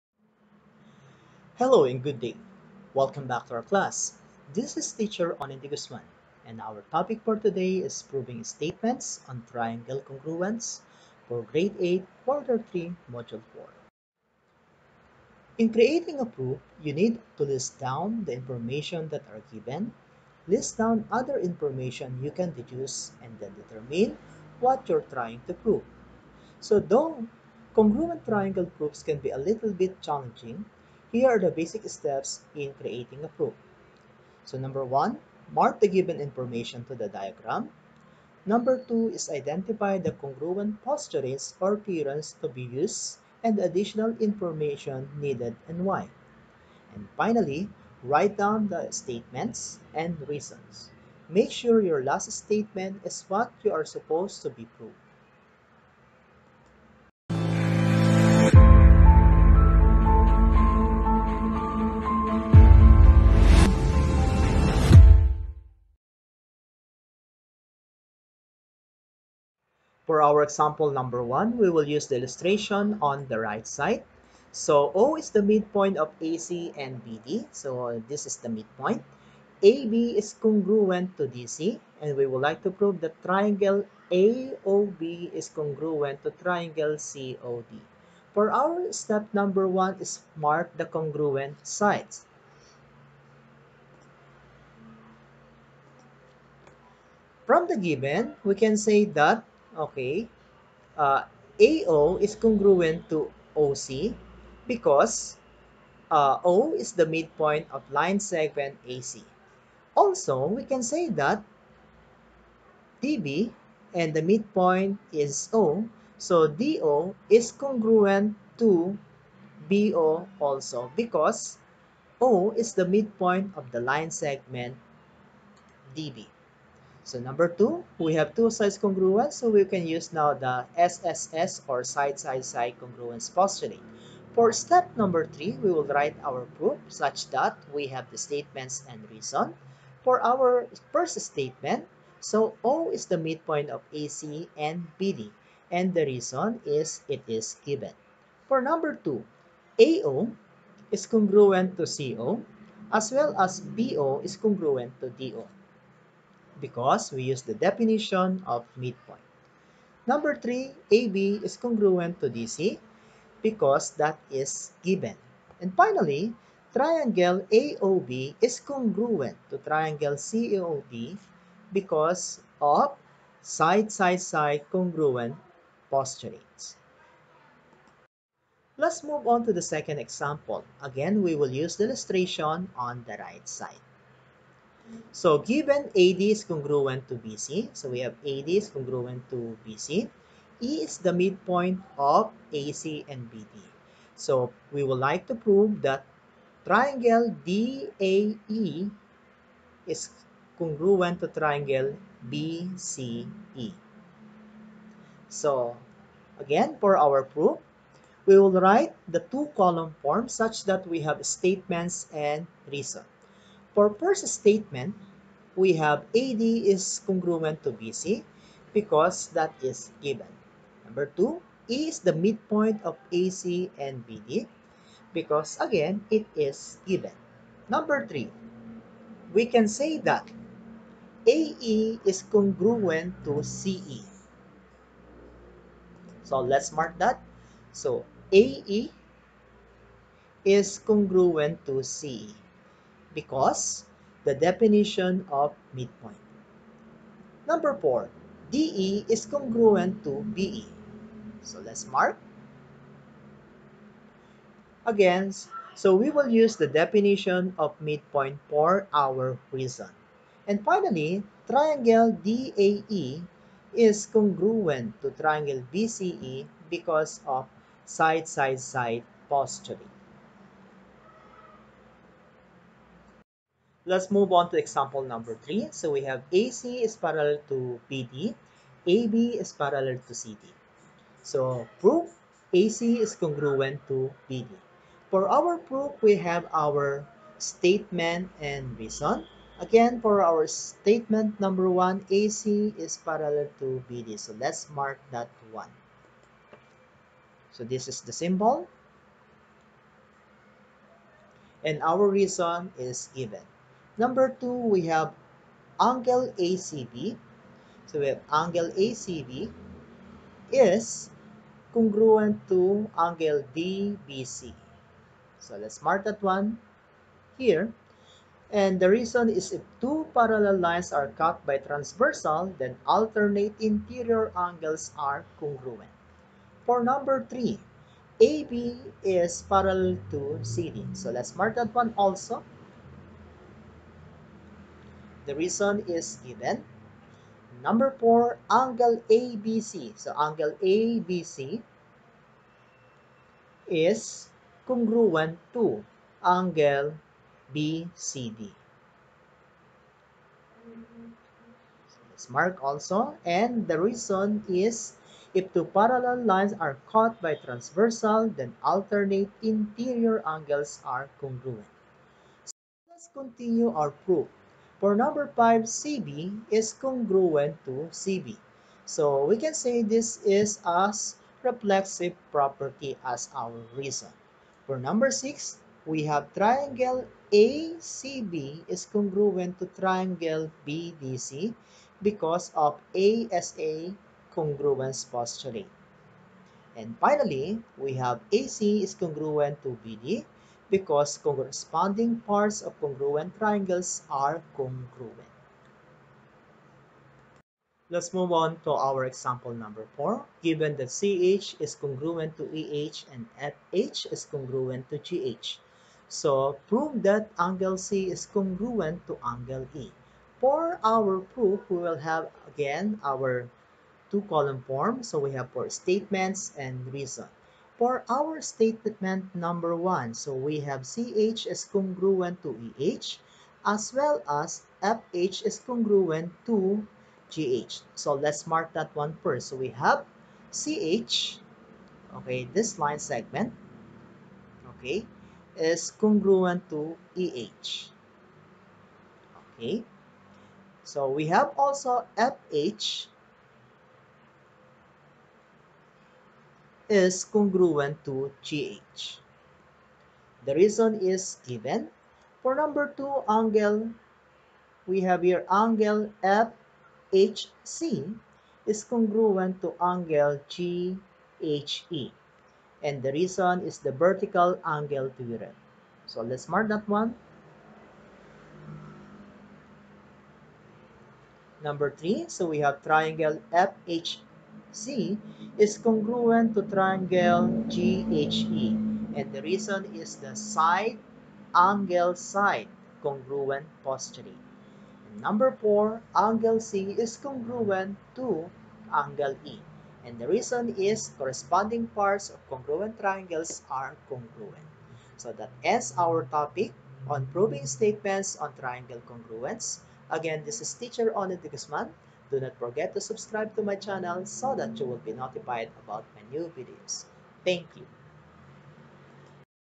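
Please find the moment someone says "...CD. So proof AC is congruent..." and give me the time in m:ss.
4:40.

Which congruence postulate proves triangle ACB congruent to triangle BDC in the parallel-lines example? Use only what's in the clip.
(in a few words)
ASA.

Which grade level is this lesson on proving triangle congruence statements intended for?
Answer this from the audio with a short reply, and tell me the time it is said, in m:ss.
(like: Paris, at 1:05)
Grade 8, at 0:11.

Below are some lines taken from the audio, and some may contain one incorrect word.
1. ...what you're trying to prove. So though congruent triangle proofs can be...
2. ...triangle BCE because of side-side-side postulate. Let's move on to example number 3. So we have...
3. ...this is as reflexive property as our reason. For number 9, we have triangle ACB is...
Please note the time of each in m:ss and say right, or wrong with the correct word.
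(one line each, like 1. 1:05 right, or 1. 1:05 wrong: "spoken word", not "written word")
1. 0:24 right
2. 4:25 right
3. 6:09 wrong: "6", not "9".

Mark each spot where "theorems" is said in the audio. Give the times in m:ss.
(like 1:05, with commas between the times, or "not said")
0:41.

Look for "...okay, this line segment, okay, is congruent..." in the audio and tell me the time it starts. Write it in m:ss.
7:12.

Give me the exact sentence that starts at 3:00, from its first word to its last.
Again, we will use the illustration on the right side.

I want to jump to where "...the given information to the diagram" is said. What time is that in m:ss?
0:35.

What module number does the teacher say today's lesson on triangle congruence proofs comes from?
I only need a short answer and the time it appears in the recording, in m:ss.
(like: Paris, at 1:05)
Module 4, at 0:13.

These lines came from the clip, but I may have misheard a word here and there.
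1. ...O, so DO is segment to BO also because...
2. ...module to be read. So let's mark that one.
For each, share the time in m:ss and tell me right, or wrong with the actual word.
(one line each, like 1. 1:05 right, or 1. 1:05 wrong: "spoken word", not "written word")
1. 1:55 wrong: "congruent", not "segment"
2. 7:44 wrong: "angle", not "module".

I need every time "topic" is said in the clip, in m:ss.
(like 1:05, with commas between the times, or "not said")
0:06, 8:16.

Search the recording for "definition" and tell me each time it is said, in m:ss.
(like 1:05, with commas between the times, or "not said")
2:37, 4:04, 4:16.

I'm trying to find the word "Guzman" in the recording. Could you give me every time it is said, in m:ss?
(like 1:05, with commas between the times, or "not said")
0:05, 8:21.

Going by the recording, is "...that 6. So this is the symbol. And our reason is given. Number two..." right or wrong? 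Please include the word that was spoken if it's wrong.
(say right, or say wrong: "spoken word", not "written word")
wrong: "1", not "6".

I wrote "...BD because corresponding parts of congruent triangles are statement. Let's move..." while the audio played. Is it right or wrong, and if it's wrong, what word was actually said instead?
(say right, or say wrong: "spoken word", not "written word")
wrong: "congruent", not "statement".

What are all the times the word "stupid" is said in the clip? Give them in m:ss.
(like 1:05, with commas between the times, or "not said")
not said.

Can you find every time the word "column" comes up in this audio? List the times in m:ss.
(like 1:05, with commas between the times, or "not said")
3:29, 6:54.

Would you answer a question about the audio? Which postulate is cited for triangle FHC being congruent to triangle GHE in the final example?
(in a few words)
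Side angle side.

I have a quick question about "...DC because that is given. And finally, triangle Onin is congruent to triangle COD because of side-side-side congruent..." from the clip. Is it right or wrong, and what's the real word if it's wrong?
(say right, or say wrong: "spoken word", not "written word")
wrong: "AOB", not "Onin".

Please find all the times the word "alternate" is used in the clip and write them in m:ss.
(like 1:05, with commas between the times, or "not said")
5:22, 5:58.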